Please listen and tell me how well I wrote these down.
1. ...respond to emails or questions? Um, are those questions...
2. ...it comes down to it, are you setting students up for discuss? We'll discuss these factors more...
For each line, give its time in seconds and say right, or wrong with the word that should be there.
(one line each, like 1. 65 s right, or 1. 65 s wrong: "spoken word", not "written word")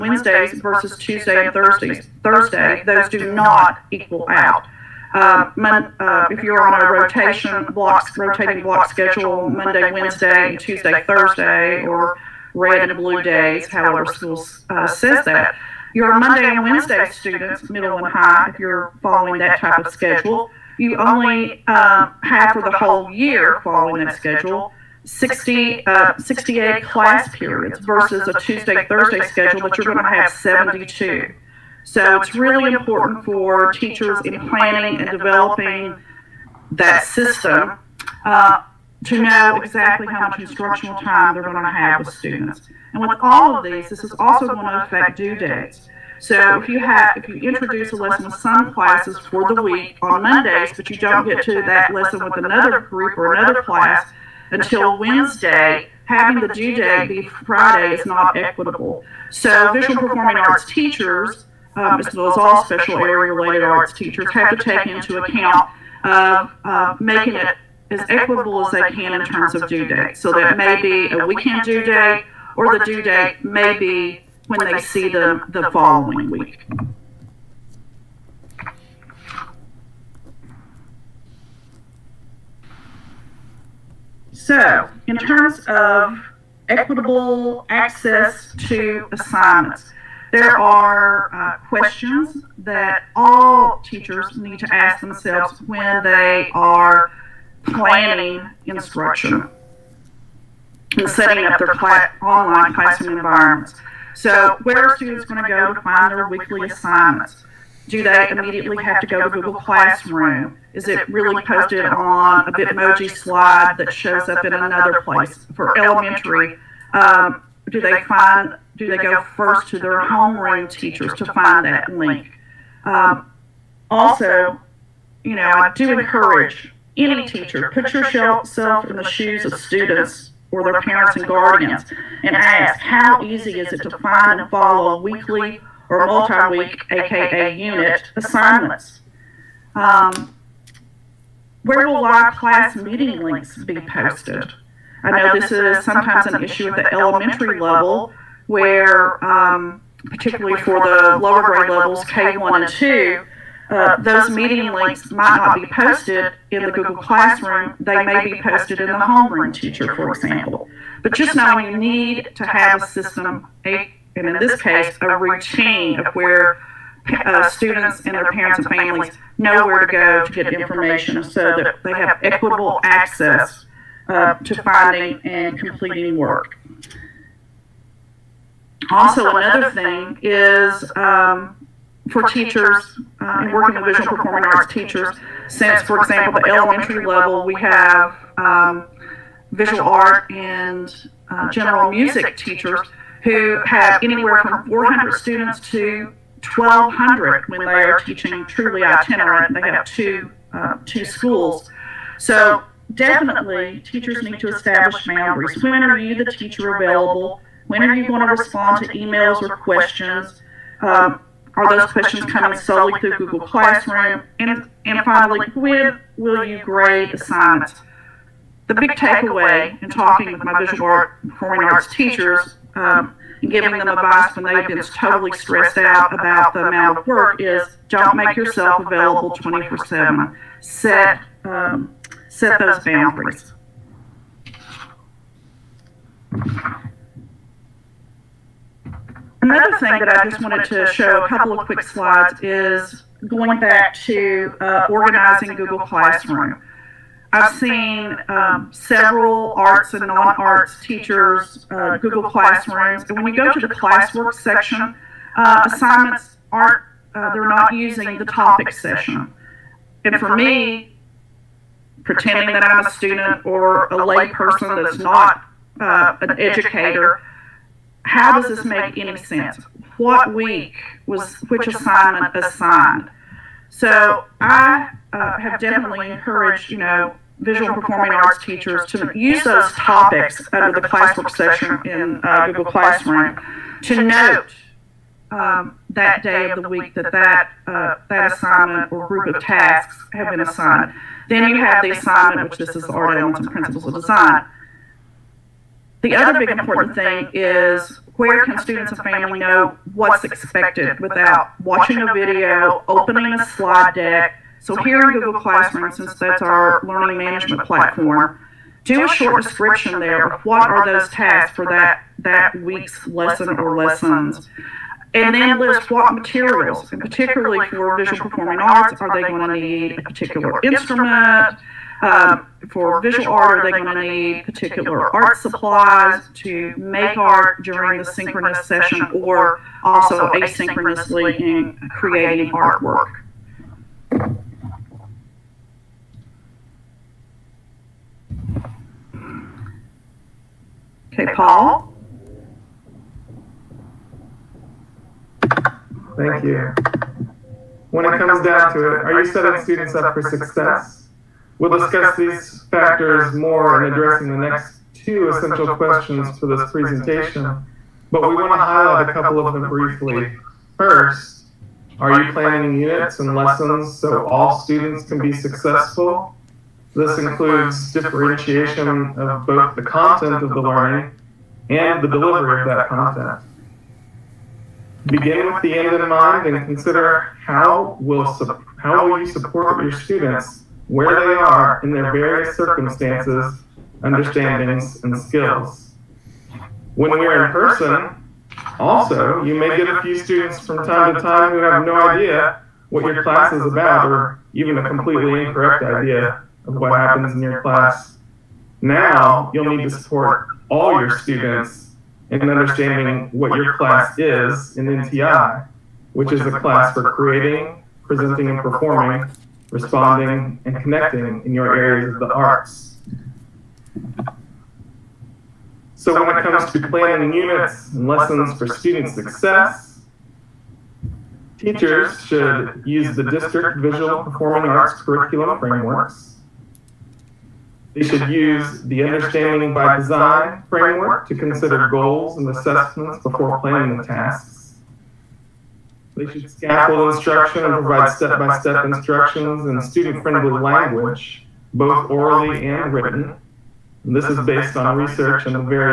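1. 208 s right
2. 348 s wrong: "success", not "discuss".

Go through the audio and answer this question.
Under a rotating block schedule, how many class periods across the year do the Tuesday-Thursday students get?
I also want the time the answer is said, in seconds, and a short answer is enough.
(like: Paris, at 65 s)
72, at 30 s.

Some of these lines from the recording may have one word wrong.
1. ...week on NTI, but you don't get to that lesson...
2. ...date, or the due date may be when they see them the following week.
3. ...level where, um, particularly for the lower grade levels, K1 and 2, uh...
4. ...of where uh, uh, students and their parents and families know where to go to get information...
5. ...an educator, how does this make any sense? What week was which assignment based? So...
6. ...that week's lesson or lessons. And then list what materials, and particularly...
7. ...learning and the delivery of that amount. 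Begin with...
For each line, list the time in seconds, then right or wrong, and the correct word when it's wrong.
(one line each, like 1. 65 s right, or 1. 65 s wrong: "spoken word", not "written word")
1. 49 s wrong: "Mondays", not "NTI"
2. 71 s right
3. 147 s right
4. 165 s right
5. 265 s wrong: "assigned", not "based"
6. 312 s right
7. 370 s wrong: "content", not "amount".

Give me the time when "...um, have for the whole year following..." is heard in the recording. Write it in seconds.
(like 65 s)
21 s.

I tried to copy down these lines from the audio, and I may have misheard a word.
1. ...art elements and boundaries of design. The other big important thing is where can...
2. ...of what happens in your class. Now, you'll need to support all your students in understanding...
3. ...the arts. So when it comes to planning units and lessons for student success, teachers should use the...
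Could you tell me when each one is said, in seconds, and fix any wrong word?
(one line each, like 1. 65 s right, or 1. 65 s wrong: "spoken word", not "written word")
1. 292 s wrong: "principles", not "boundaries"
2. 396 s right
3. 412 s right.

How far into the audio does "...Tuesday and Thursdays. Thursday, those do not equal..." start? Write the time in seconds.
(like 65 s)
0 s.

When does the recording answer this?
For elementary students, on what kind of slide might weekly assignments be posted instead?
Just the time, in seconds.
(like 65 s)
112 s.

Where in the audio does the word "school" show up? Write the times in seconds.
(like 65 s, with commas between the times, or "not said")
14 s, 201 s.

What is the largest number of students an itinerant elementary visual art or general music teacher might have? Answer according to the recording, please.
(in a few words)
1,200.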